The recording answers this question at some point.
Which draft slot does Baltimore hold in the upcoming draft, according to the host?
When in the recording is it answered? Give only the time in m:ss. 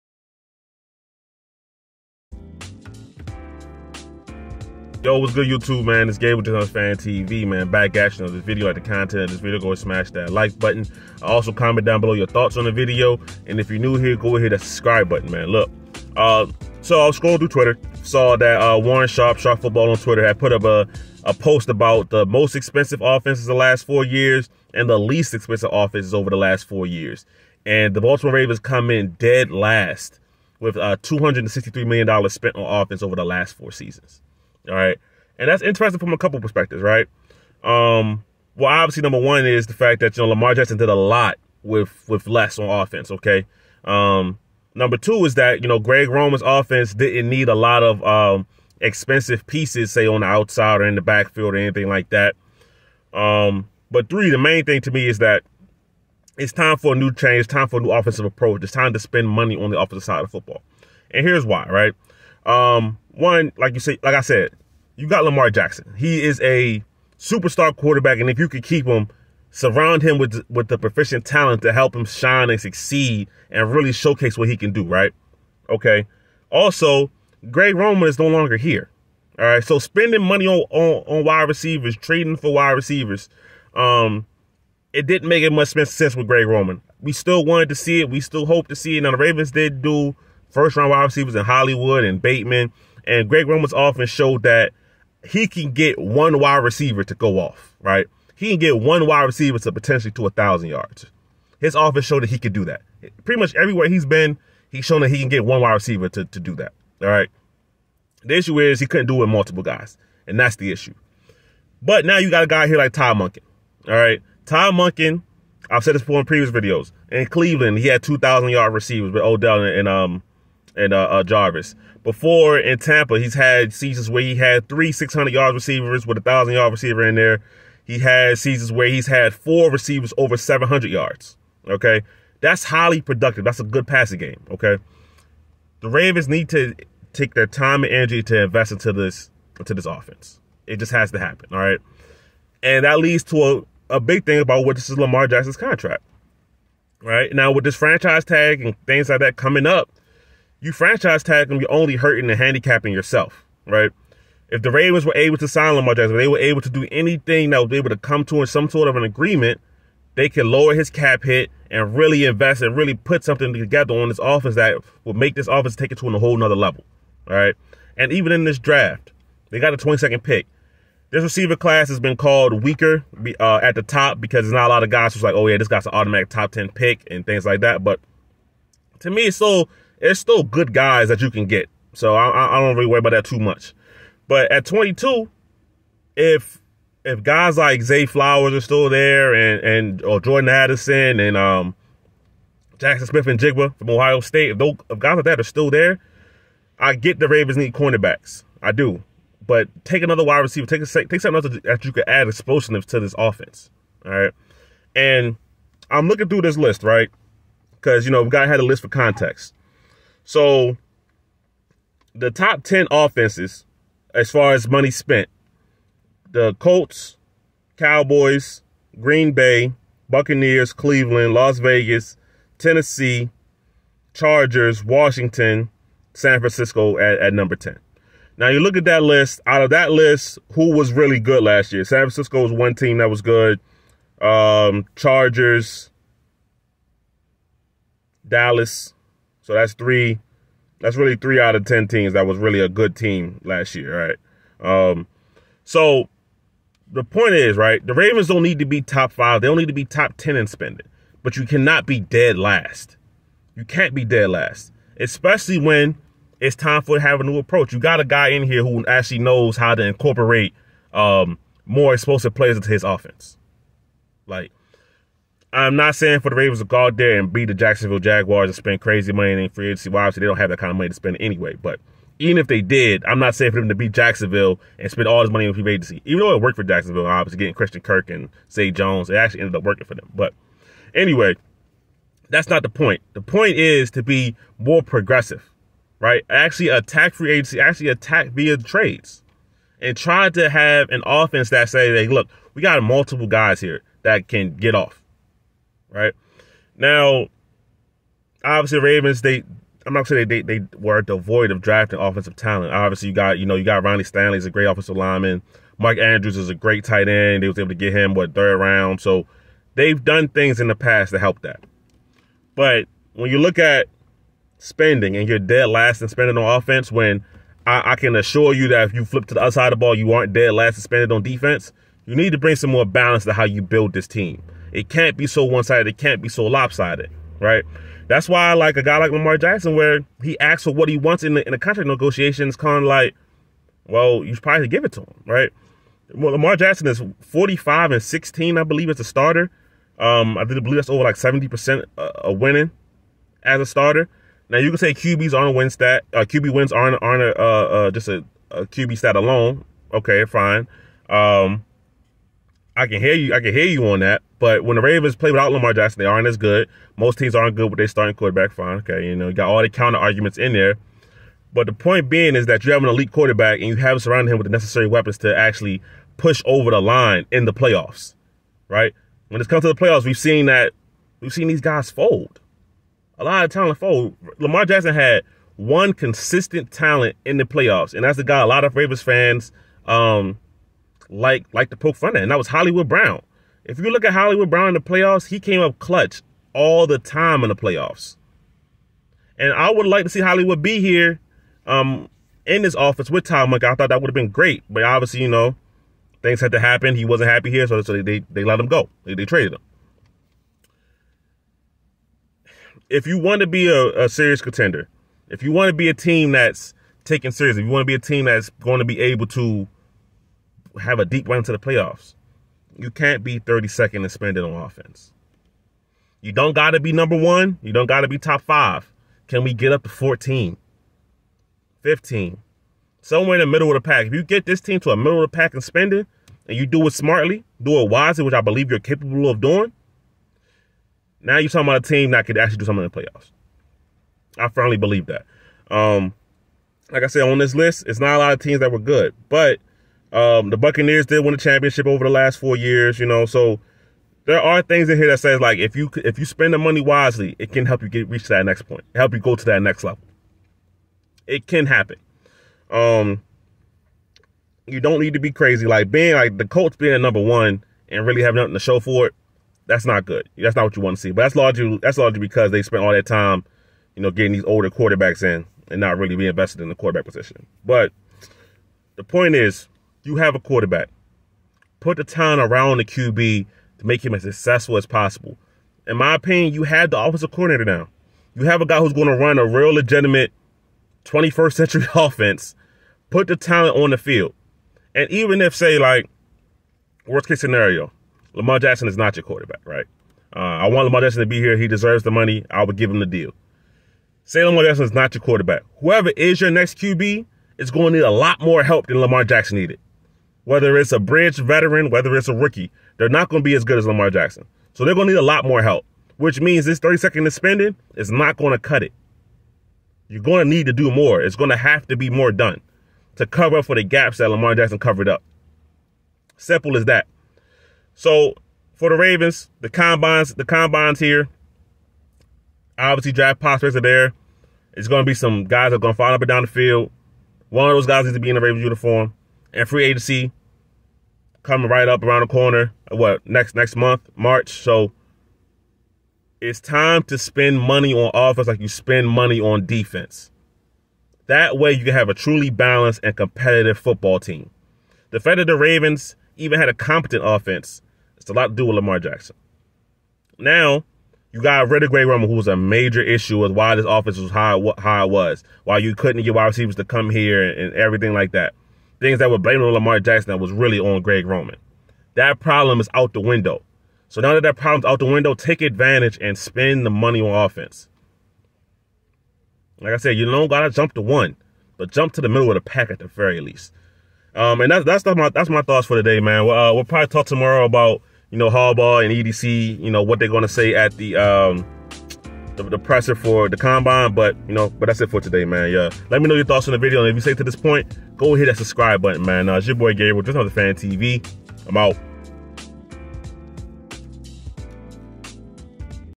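2:49.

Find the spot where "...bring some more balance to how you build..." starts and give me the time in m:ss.
5:22.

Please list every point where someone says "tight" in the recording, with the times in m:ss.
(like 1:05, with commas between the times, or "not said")
5:06.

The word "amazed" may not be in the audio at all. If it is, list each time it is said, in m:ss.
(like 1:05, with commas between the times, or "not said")
not said.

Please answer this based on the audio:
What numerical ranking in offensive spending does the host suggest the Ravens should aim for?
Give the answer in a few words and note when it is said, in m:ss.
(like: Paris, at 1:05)
14 or 15, at 6:59.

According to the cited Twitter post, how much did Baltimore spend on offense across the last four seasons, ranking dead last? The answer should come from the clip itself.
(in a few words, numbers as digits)
$263 million.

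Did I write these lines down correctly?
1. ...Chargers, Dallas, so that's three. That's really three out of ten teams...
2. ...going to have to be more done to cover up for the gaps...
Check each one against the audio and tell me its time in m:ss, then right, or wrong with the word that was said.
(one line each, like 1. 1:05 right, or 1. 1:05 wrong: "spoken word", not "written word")
1. 3:54 right
2. 8:31 right.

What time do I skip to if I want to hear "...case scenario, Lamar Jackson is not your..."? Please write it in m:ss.
8:07.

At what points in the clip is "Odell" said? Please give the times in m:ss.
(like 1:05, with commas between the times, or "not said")
1:59.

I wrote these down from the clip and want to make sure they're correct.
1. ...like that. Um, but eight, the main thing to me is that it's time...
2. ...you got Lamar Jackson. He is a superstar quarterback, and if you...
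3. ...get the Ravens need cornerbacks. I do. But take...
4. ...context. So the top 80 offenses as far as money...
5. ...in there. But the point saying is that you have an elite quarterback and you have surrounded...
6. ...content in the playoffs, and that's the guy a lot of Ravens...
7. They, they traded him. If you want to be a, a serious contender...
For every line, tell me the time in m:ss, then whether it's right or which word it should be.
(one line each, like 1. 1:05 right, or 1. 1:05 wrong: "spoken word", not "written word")
1. 0:51 wrong: "three", not "eight"
2. 1:05 right
3. 3:16 right
4. 3:28 wrong: "10", not "80"
5. 6:00 wrong: "being", not "saying"
6. 6:16 wrong: "talent", not "content"
7. 6:39 right.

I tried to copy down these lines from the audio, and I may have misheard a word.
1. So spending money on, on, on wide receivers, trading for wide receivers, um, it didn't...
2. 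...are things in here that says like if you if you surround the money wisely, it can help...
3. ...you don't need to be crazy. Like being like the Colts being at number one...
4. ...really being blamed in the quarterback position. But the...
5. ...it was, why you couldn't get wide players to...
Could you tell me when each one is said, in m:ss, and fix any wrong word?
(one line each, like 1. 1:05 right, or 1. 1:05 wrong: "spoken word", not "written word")
1. 1:19 right
2. 7:24 wrong: "spend", not "surround"
3. 7:34 right
4. 7:45 wrong: "invested", not "blamed"
5. 9:15 wrong: "receivers", not "players".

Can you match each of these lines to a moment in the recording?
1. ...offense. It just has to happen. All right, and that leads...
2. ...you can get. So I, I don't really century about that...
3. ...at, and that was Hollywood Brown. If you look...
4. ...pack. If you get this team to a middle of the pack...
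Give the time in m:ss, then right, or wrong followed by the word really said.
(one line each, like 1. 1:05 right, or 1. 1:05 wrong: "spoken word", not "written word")
1. 2:19 right
2. 3:01 wrong: "worry", not "century"
3. 6:22 right
4. 7:03 right.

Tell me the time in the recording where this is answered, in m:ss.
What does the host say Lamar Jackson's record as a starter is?
5:37.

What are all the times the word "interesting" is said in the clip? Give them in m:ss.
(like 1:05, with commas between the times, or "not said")
0:35.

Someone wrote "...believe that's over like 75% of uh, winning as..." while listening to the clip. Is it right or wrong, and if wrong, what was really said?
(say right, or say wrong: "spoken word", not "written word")
wrong: "70", not "75".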